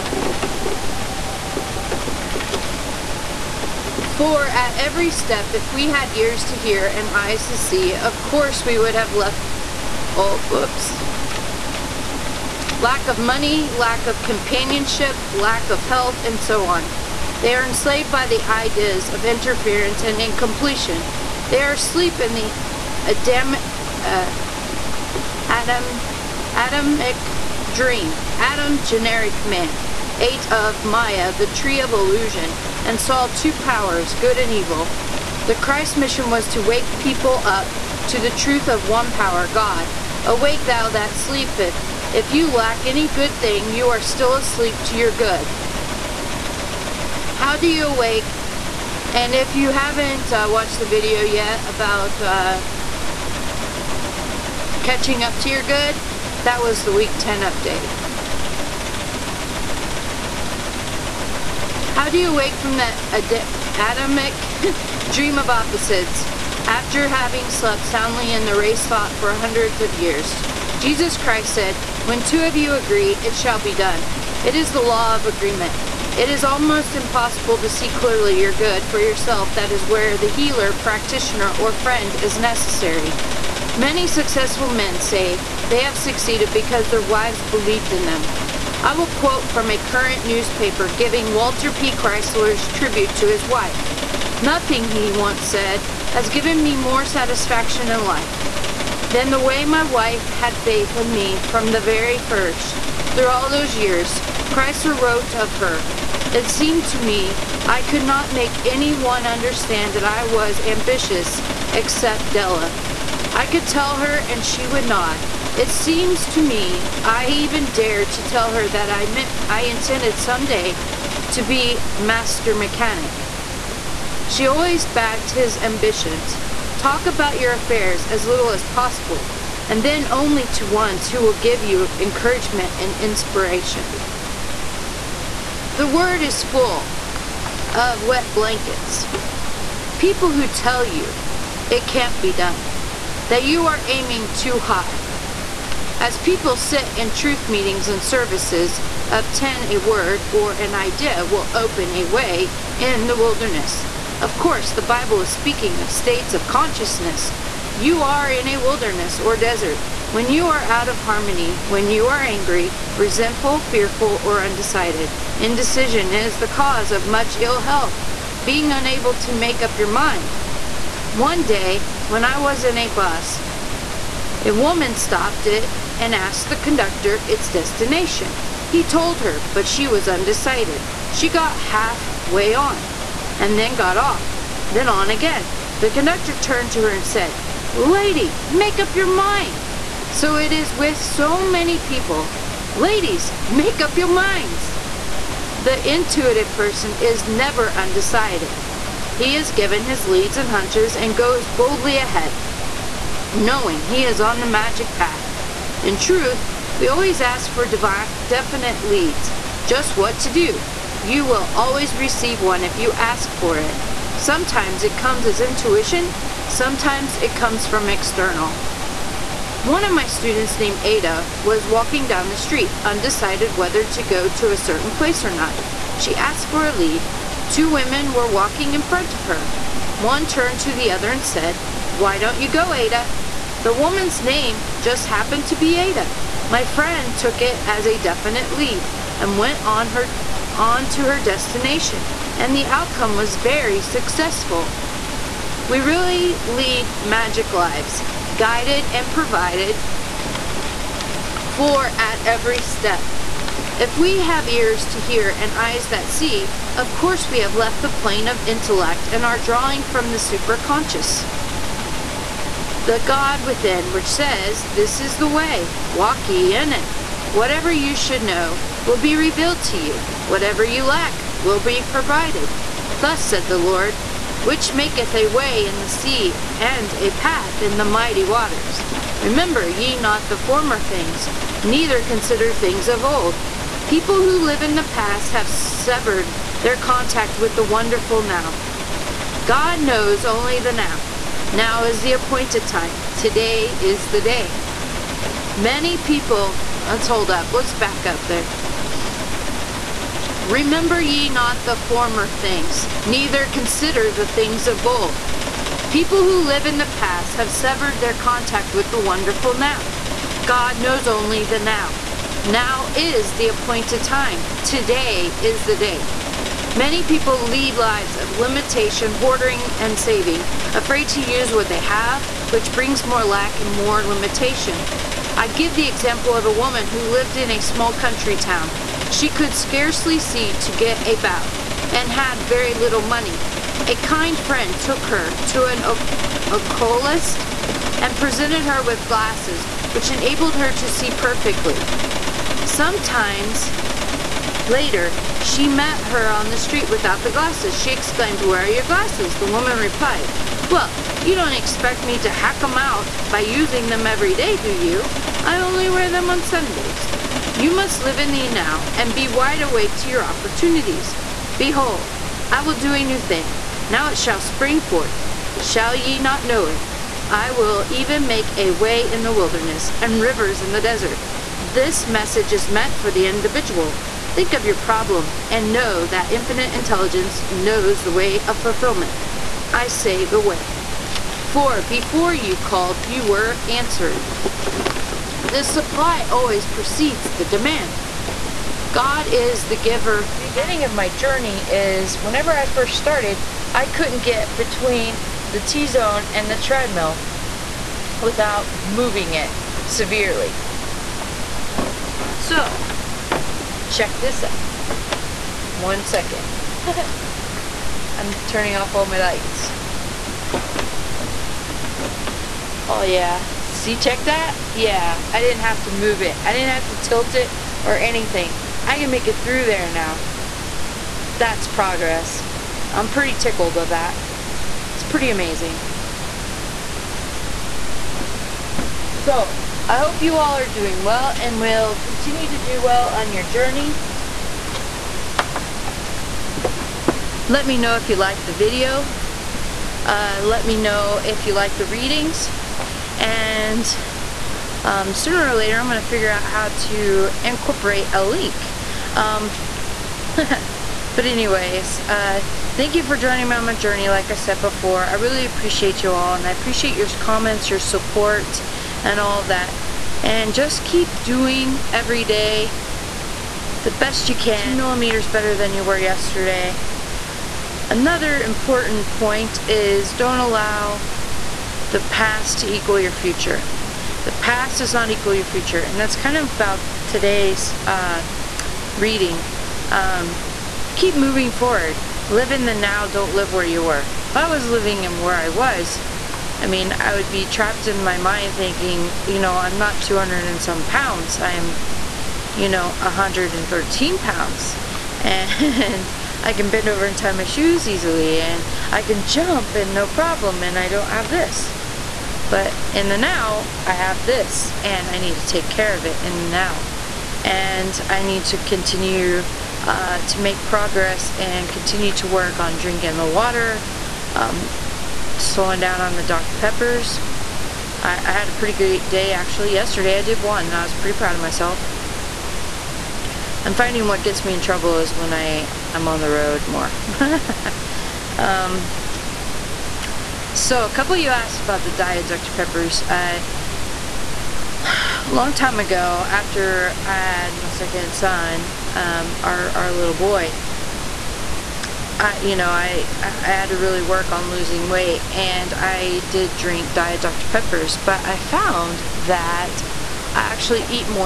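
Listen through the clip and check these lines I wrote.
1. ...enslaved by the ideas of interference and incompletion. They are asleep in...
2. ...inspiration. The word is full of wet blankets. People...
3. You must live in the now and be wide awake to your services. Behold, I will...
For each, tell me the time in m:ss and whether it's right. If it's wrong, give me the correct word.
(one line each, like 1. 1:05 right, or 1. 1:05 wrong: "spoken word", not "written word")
1. 0:17 right
2. 2:12 right
3. 5:57 wrong: "opportunities", not "services".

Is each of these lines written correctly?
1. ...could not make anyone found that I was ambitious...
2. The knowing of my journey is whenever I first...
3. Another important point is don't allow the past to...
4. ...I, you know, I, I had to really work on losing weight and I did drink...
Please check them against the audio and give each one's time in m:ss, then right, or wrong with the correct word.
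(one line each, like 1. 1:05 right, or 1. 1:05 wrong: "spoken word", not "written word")
1. 1:47 wrong: "understand", not "found"
2. 6:30 wrong: "beginning", not "knowing"
3. 7:47 right
4. 9:02 right.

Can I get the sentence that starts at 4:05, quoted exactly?
We really lead magic lives, guided and provided for at every step.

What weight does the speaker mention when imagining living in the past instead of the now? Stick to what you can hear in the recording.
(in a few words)
113 pounds.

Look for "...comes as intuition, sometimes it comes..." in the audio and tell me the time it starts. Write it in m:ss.
3:34.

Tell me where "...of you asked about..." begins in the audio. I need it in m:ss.
8:51.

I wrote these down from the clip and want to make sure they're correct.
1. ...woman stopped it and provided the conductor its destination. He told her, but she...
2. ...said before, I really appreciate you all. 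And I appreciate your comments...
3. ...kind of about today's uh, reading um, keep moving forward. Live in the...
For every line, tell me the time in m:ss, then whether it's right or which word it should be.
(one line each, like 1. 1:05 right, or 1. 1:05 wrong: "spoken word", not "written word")
1. 2:54 wrong: "asked", not "provided"
2. 7:34 right
3. 7:56 right.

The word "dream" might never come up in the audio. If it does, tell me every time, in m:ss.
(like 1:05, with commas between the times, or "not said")
0:27, 1:05.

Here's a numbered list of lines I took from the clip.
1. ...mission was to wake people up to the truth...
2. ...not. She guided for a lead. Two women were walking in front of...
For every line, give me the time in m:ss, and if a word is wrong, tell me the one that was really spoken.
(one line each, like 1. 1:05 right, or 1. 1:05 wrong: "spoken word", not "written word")
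1. 0:35 right
2. 3:45 wrong: "asked", not "guided".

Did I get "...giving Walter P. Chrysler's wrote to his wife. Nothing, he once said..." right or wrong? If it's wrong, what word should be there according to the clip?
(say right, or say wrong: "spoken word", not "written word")
wrong: "tribute", not "wrote".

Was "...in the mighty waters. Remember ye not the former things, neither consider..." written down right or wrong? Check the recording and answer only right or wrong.
right.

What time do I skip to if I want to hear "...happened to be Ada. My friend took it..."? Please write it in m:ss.
3:55.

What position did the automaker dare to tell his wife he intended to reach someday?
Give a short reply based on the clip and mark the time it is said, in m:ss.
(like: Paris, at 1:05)
master mechanic, at 2:01.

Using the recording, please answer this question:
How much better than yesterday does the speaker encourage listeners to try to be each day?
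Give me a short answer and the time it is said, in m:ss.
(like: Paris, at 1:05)
2 millimeters, at 7:44.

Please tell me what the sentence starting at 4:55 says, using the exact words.
Many people, let's hold up, let's back up there.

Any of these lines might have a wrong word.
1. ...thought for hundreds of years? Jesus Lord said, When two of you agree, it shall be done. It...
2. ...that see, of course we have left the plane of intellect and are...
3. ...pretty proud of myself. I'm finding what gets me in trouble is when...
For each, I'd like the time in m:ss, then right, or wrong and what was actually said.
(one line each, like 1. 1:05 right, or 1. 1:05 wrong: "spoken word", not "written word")
1. 1:08 wrong: "Christ", not "Lord"
2. 4:15 right
3. 8:40 right.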